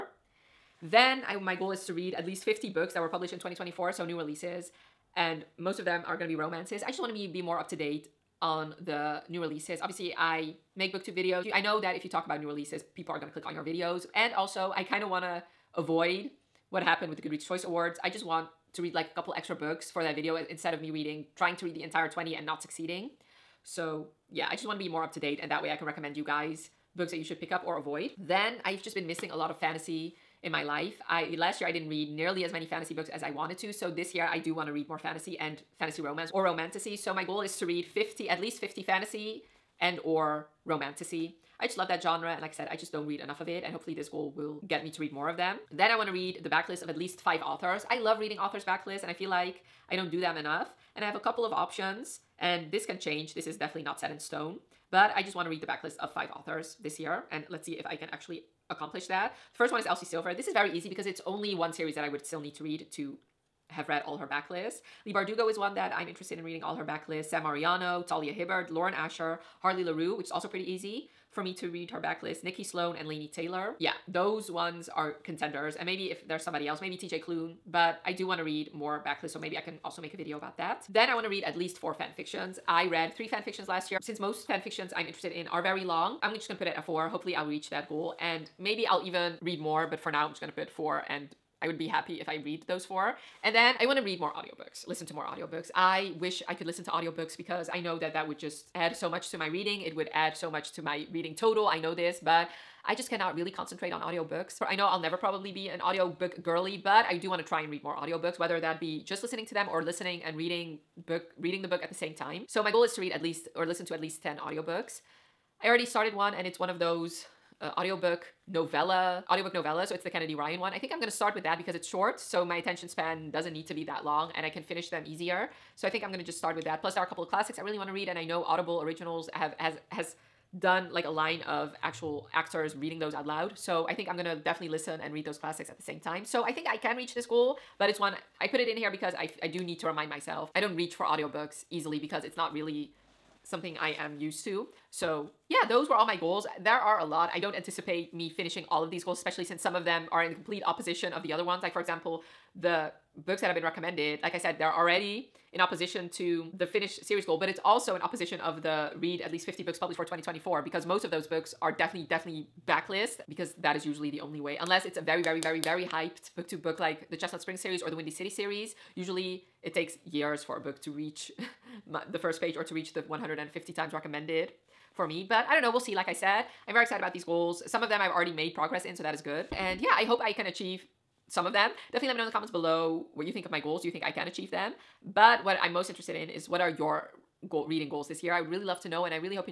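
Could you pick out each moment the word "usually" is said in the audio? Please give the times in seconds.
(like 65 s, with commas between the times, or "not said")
163 s, 168 s.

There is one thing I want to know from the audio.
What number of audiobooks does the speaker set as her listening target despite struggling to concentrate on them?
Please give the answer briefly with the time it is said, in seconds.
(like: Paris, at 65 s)
10, at 114 s.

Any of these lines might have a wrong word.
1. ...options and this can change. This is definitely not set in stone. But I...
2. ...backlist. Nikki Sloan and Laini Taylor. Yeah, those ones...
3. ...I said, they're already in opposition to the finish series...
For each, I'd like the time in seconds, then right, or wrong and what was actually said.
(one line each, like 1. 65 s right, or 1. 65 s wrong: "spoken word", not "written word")
1. 51 s right
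2. 71 s right
3. 154 s right.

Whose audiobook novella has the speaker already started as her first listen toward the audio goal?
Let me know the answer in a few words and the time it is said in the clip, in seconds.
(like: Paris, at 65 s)
Kennedy Ryan, at 120 s.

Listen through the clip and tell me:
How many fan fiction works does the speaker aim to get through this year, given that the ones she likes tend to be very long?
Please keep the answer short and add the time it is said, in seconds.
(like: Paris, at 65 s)
4, at 86 s.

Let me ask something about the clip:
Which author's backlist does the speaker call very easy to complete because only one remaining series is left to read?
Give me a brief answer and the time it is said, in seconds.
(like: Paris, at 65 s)
Elsie Silver, at 59 s.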